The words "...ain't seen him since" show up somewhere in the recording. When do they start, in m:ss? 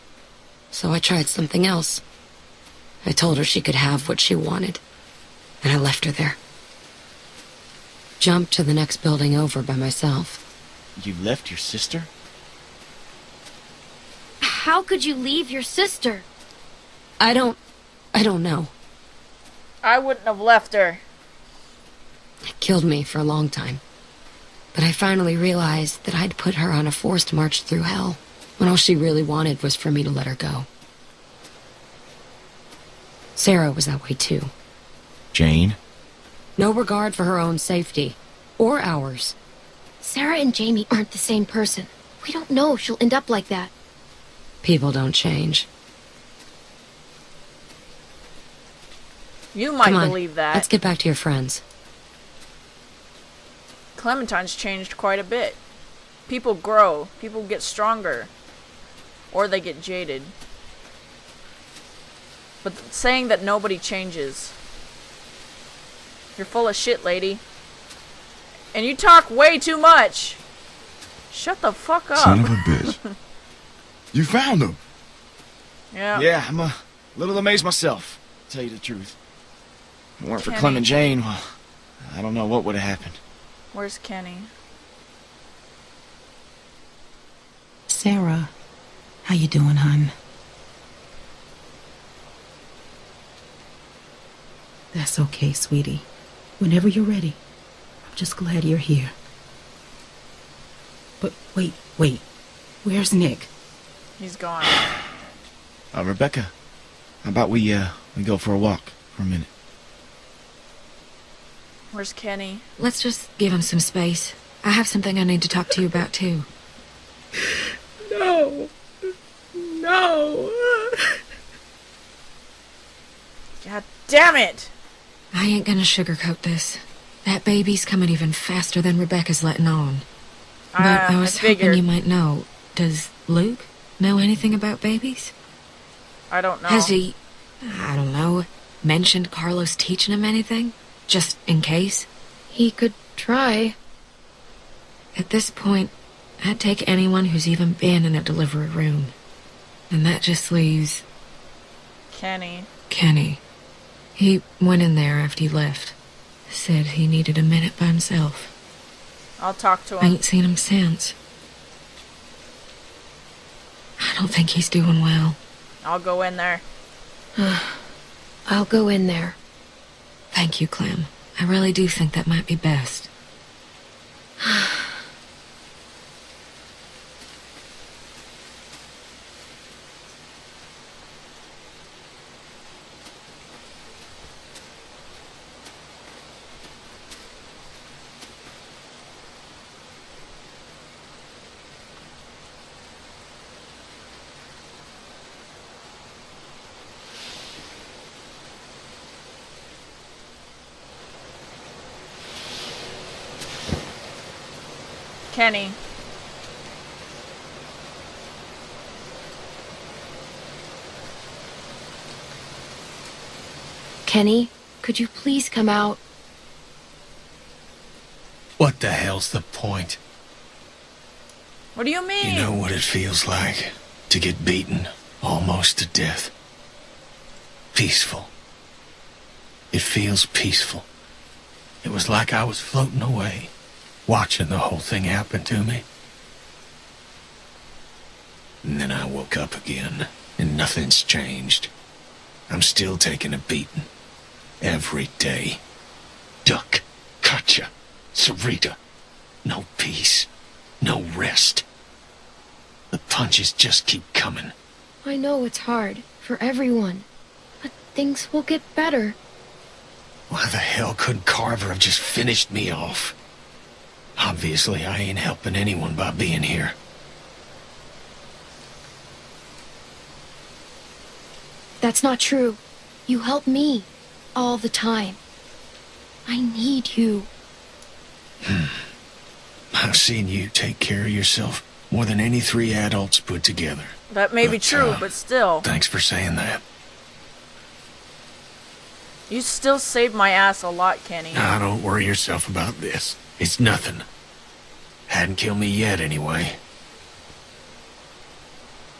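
2:40.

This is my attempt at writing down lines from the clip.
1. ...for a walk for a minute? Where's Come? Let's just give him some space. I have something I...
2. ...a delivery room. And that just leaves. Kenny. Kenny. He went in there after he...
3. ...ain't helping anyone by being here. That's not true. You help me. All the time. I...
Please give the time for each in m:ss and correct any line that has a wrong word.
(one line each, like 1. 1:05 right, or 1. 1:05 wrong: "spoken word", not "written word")
1. 1:48 wrong: "Kenny", not "Come"
2. 2:28 right
3. 4:24 right.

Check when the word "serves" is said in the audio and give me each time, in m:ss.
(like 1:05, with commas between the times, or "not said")
not said.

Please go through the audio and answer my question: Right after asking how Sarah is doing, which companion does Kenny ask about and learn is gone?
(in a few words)
Nick.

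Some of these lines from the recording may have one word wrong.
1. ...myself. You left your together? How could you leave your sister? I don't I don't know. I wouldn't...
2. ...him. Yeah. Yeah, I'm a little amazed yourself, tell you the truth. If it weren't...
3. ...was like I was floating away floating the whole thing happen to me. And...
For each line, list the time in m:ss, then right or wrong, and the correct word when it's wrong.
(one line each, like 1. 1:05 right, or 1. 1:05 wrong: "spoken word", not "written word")
1. 0:09 wrong: "sister", not "together"
2. 1:14 wrong: "myself", not "yourself"
3. 3:51 wrong: "watching", not "floating".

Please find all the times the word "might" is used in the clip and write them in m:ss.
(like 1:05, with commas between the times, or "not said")
0:49, 2:11, 2:52.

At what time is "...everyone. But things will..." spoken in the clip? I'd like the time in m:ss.
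4:16.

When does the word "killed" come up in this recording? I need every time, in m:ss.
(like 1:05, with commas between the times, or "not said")
0:22, 4:55.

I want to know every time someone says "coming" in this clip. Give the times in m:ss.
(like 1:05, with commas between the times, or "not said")
2:07, 4:14.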